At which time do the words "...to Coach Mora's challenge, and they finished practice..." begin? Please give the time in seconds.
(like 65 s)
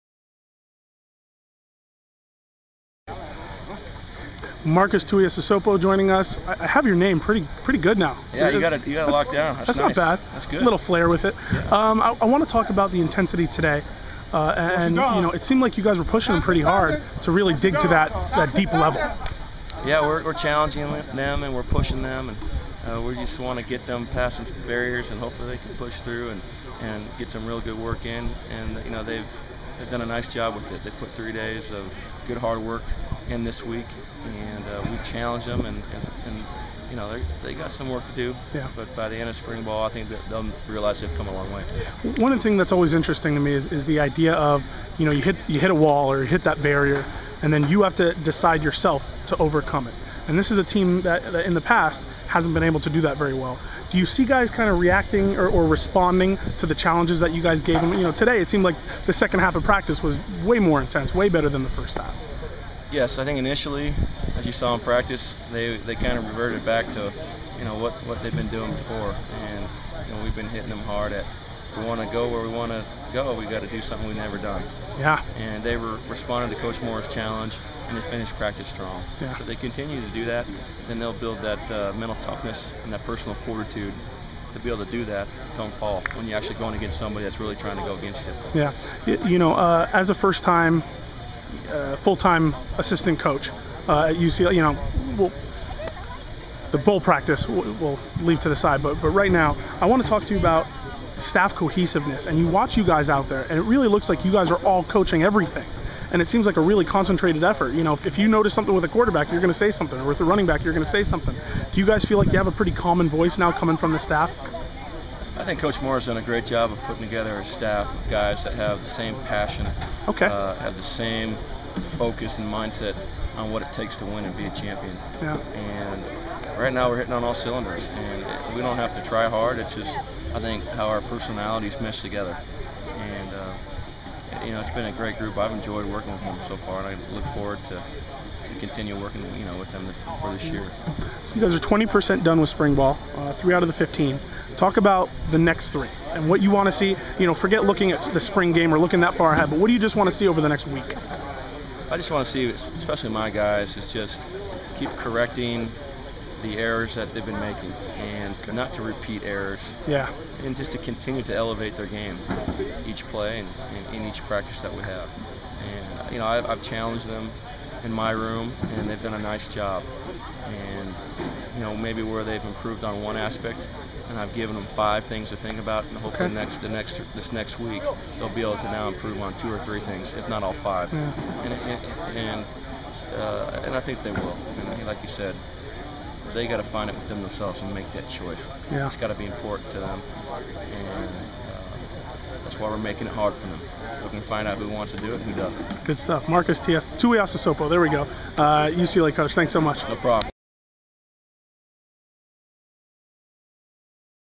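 76 s.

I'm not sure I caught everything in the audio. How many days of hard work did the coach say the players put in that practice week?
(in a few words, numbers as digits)
3.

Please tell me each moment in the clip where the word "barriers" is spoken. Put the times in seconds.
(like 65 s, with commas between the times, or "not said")
24 s, 46 s.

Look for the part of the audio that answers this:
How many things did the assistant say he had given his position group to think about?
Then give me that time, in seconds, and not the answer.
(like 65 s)
174 s.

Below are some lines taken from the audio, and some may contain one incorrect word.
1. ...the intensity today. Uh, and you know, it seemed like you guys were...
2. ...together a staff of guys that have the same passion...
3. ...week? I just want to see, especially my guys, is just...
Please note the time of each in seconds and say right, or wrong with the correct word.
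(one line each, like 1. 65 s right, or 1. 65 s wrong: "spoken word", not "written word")
1. 12 s right
2. 117 s right
3. 150 s right.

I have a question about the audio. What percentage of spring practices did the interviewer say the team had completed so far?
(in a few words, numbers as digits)
20%.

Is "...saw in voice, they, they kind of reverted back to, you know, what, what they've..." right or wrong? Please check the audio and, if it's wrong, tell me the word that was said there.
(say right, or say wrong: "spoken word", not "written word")
wrong: "practice", not "voice".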